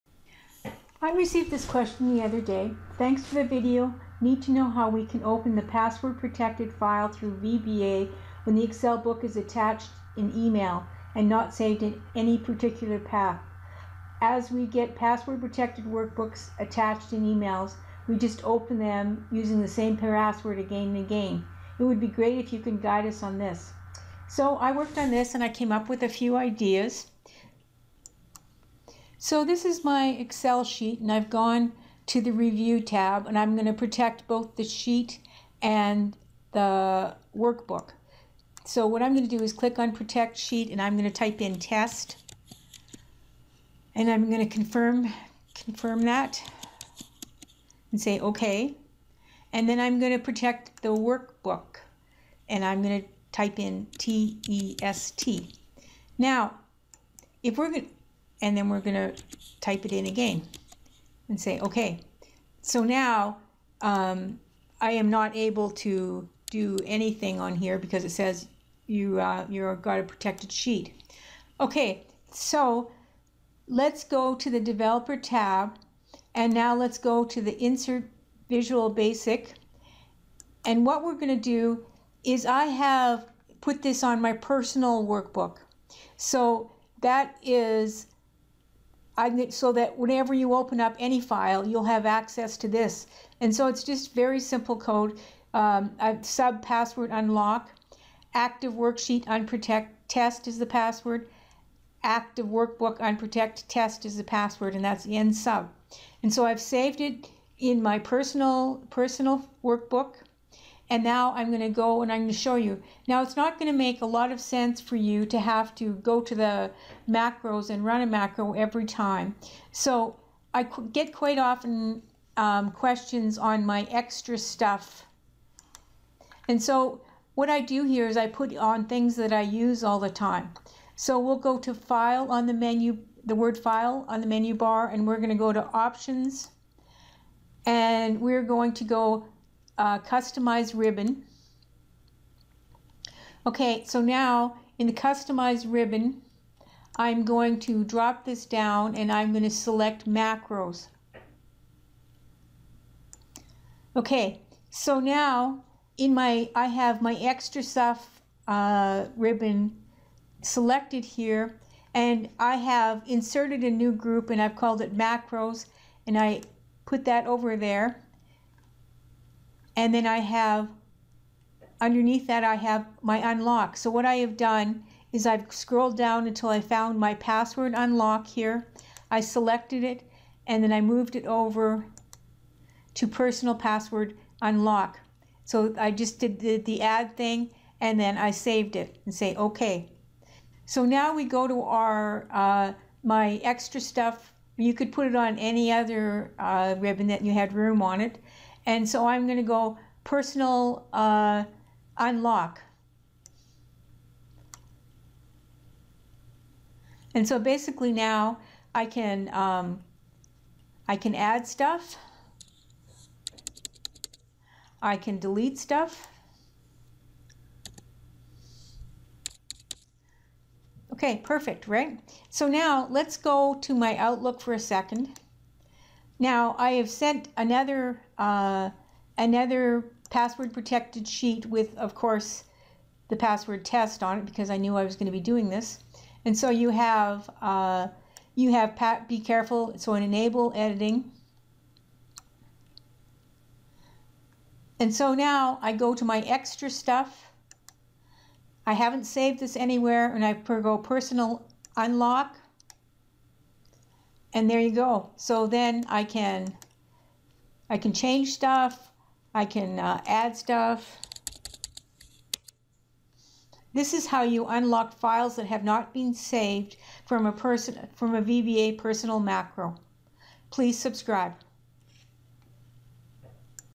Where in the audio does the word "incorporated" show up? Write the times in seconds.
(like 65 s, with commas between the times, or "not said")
not said.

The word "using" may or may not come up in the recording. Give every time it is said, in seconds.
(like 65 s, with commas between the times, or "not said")
19 s.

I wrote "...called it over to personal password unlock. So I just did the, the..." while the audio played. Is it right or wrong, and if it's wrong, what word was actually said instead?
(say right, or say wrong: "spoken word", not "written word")
wrong: "moved", not "called".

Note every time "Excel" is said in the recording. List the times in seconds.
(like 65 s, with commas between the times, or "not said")
8 s, 30 s.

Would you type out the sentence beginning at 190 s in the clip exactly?
So now we go to our uh, my extra stuff.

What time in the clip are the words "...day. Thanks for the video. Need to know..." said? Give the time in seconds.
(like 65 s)
2 s.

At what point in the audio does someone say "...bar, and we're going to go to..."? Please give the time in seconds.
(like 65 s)
134 s.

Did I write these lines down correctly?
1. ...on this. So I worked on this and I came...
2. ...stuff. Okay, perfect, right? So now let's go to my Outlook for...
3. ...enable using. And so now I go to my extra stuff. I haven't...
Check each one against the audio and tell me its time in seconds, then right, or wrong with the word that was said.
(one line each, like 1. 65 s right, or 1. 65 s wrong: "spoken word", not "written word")
1. 23 s right
2. 215 s right
3. 240 s wrong: "editing", not "using".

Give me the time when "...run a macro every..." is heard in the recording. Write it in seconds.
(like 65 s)
117 s.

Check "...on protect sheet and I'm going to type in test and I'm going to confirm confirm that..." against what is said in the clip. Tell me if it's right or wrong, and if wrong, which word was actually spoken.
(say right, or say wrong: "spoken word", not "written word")
right.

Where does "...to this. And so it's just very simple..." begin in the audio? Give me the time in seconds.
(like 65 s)
92 s.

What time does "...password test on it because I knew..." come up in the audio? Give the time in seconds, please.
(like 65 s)
233 s.